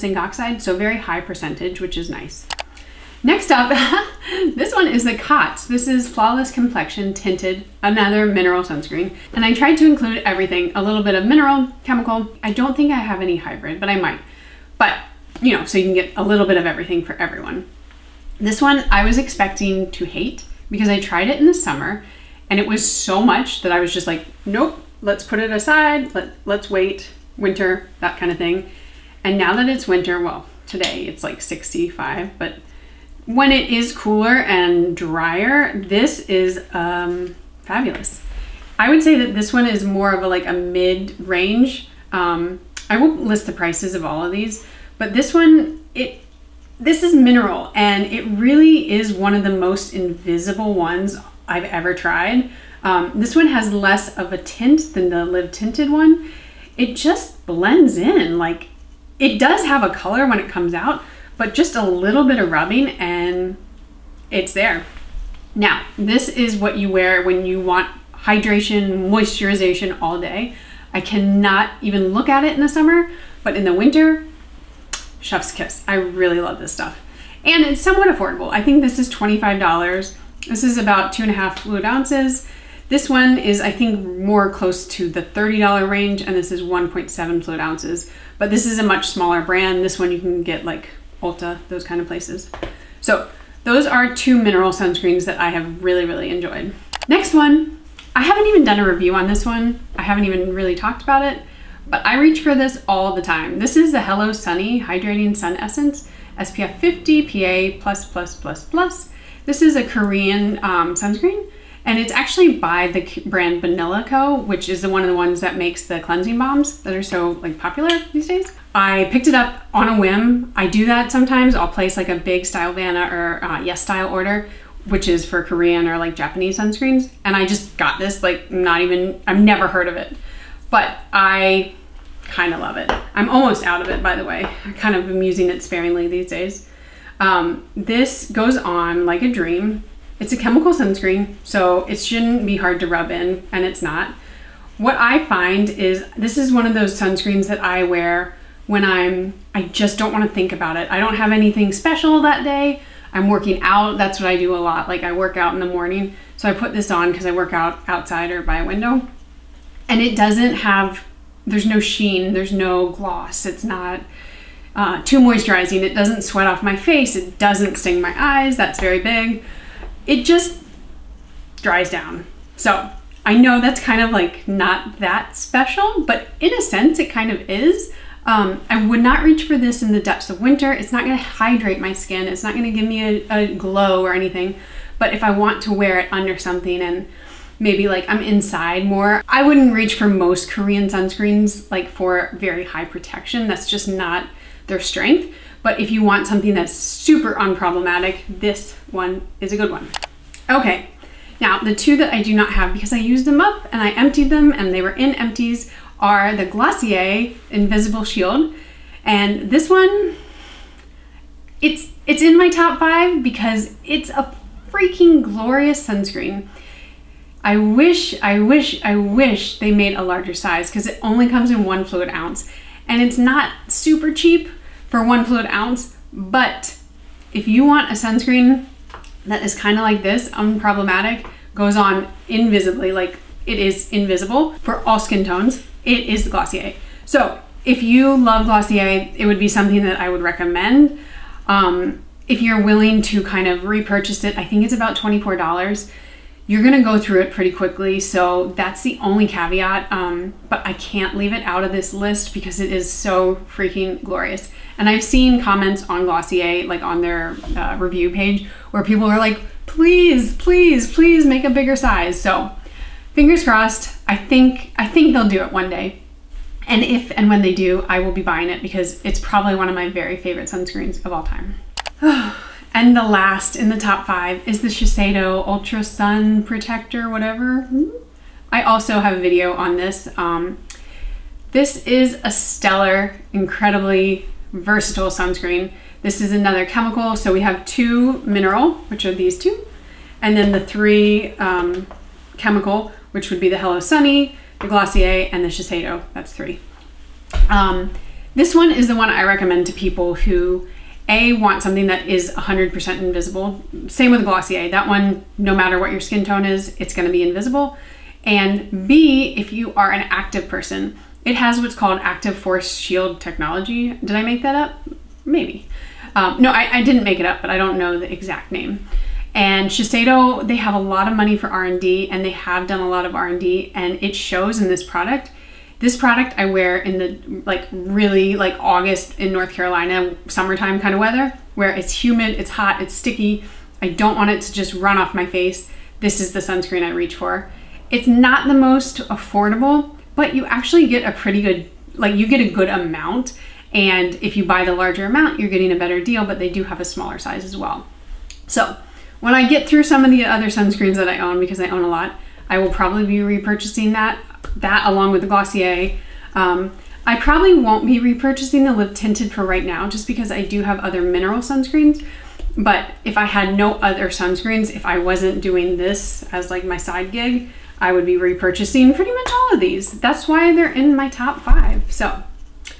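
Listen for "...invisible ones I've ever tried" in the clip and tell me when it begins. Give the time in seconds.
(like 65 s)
49 s.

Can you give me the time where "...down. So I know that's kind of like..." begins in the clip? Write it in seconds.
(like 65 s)
171 s.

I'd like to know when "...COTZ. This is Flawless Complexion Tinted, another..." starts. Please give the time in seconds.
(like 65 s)
5 s.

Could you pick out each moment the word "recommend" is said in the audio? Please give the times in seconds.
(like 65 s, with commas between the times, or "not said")
240 s, 299 s.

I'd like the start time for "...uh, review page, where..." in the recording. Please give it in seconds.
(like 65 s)
257 s.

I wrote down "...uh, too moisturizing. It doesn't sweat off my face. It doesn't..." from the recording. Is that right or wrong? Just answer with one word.
right.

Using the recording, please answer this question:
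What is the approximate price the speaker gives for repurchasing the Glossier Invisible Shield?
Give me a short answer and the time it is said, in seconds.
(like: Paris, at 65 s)
$24, at 244 s.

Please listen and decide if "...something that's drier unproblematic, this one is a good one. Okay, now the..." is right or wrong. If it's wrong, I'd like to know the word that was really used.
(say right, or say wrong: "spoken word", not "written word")
wrong: "super", not "drier".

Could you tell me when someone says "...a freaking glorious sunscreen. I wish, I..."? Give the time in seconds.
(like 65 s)
214 s.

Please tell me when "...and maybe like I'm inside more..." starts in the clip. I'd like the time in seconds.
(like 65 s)
186 s.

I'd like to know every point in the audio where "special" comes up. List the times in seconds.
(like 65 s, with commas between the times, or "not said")
151 s, 175 s.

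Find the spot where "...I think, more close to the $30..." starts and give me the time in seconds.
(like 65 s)
83 s.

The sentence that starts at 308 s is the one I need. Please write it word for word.
And B, if you are an active person, it has what's called active force shield technology.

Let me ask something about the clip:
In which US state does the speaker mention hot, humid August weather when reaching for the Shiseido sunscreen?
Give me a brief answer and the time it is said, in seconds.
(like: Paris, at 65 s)
North Carolina, at 329 s.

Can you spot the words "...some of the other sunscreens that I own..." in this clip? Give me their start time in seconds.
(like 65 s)
349 s.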